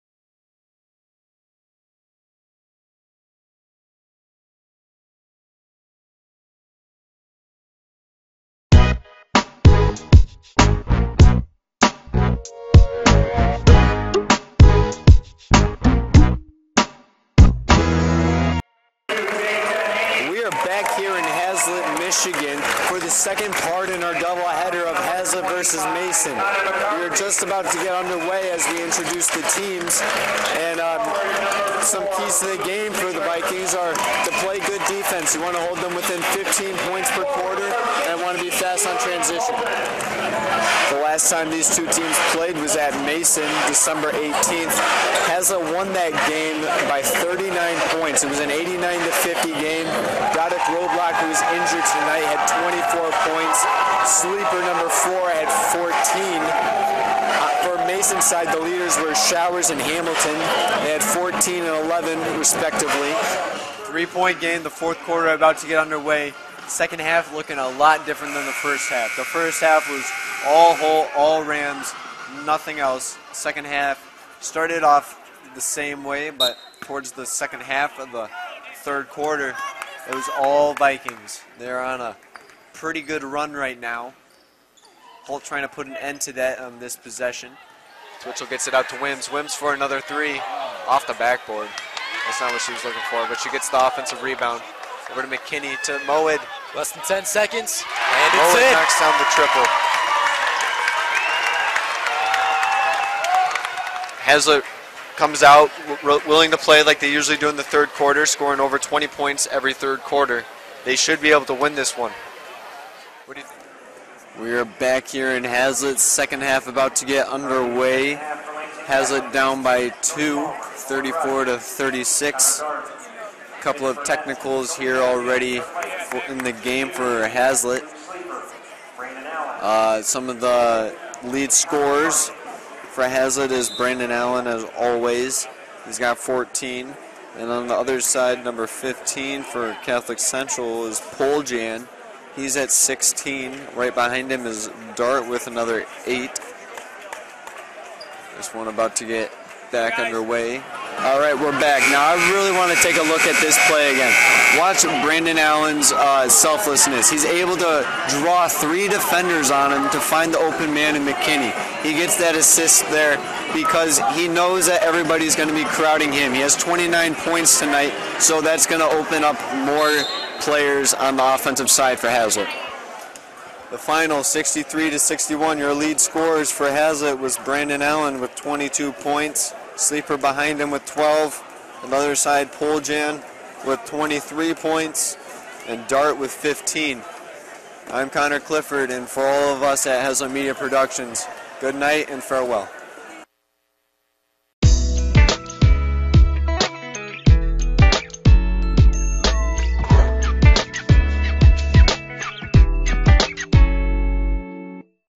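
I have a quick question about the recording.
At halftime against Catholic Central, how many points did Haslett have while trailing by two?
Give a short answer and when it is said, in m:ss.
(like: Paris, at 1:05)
34, at 2:00.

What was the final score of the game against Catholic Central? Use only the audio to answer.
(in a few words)
63 to 61.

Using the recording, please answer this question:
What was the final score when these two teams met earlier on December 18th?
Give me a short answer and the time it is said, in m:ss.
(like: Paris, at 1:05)
89 to 50, at 0:48.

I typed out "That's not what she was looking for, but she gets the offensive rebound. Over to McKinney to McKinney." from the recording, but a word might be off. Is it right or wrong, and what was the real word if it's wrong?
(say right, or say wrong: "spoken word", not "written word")
wrong: "Moed", not "McKinney".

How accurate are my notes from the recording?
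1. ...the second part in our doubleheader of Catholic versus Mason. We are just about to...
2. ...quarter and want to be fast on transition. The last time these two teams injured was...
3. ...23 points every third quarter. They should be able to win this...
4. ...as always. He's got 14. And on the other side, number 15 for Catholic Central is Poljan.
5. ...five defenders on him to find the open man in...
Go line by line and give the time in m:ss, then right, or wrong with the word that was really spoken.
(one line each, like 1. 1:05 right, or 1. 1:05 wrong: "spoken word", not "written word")
1. 0:22 wrong: "Haslett", not "Catholic"
2. 0:37 wrong: "played", not "injured"
3. 1:48 wrong: "20", not "23"
4. 2:14 right
5. 2:38 wrong: "three", not "five".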